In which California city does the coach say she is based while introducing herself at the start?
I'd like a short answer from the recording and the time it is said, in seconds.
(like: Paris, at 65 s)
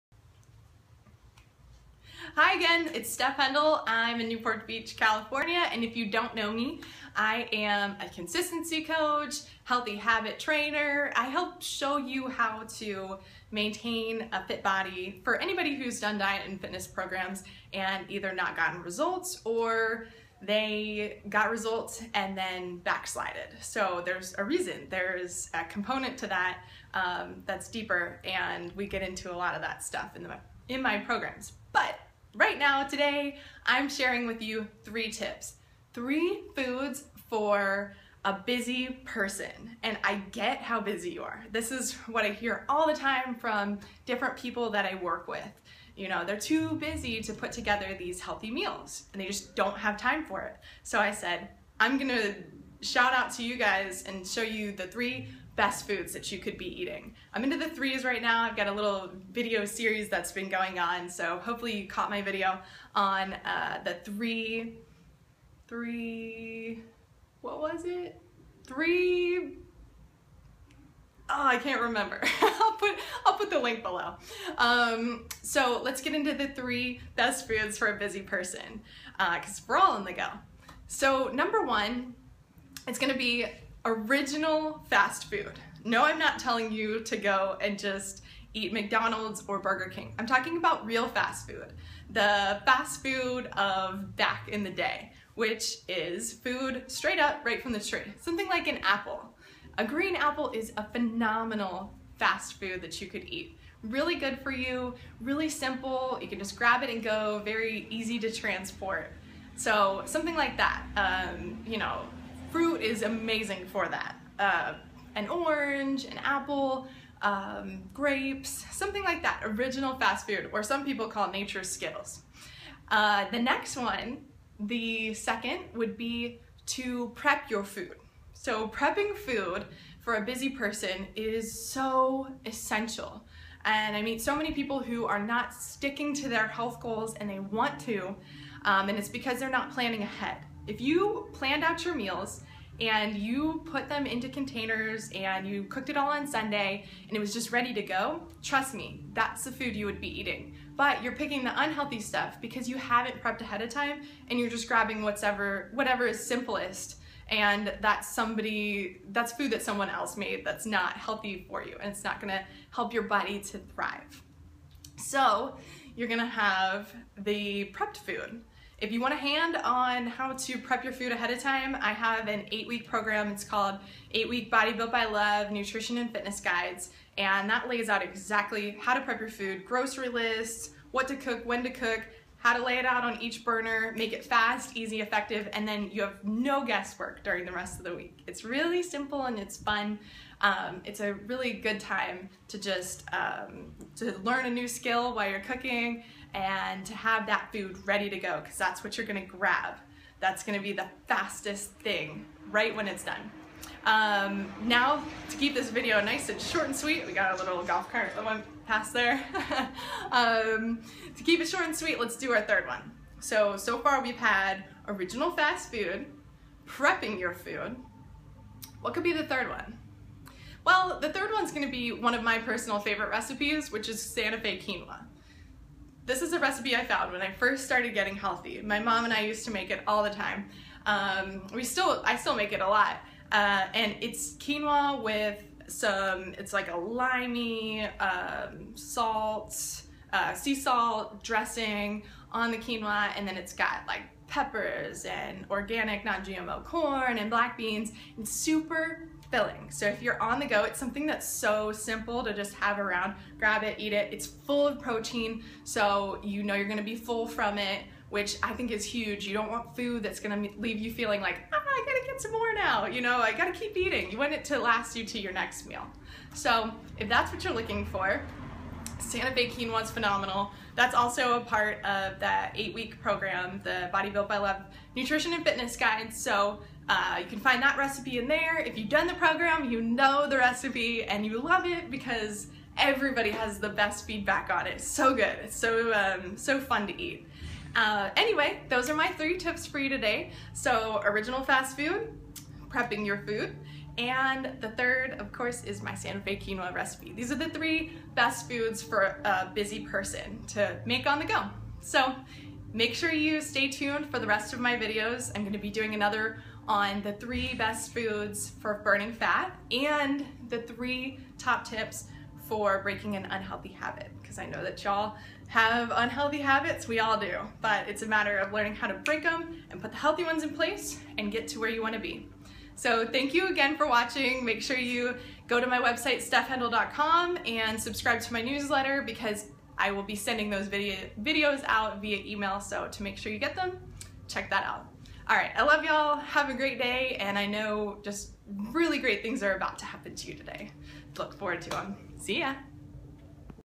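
Newport Beach, at 4 s.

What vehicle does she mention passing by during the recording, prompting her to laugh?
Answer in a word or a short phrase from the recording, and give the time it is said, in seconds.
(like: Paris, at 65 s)
golf cart, at 207 s.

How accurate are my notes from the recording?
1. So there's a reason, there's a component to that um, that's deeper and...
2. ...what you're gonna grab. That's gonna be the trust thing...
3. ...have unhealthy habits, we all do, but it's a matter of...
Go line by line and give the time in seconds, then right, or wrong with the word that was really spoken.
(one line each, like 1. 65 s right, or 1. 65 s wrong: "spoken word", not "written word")
1. 23 s right
2. 198 s wrong: "fastest", not "trust"
3. 315 s right.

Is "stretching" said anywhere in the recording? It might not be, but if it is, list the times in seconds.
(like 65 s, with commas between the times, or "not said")
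not said.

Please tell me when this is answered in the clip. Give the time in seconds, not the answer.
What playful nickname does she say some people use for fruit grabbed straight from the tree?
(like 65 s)
121 s.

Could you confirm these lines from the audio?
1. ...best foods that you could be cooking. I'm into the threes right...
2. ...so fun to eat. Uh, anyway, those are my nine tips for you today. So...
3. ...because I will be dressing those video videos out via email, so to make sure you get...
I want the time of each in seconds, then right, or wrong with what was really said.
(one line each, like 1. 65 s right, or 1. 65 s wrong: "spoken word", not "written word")
1. 55 s wrong: "eating", not "cooking"
2. 286 s wrong: "three", not "nine"
3. 329 s wrong: "sending", not "dressing".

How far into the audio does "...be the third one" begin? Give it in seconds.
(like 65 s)
219 s.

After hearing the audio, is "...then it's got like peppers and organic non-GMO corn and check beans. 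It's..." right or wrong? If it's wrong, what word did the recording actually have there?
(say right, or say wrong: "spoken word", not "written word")
wrong: "black", not "check".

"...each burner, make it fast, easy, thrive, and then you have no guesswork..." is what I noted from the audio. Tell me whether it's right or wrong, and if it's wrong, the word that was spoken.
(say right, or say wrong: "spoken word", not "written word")
wrong: "effective", not "thrive".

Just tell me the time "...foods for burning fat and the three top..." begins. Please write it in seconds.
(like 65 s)
307 s.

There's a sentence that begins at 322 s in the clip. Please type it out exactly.
So thank you again for watching.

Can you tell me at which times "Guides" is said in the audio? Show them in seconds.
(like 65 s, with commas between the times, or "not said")
176 s, 275 s.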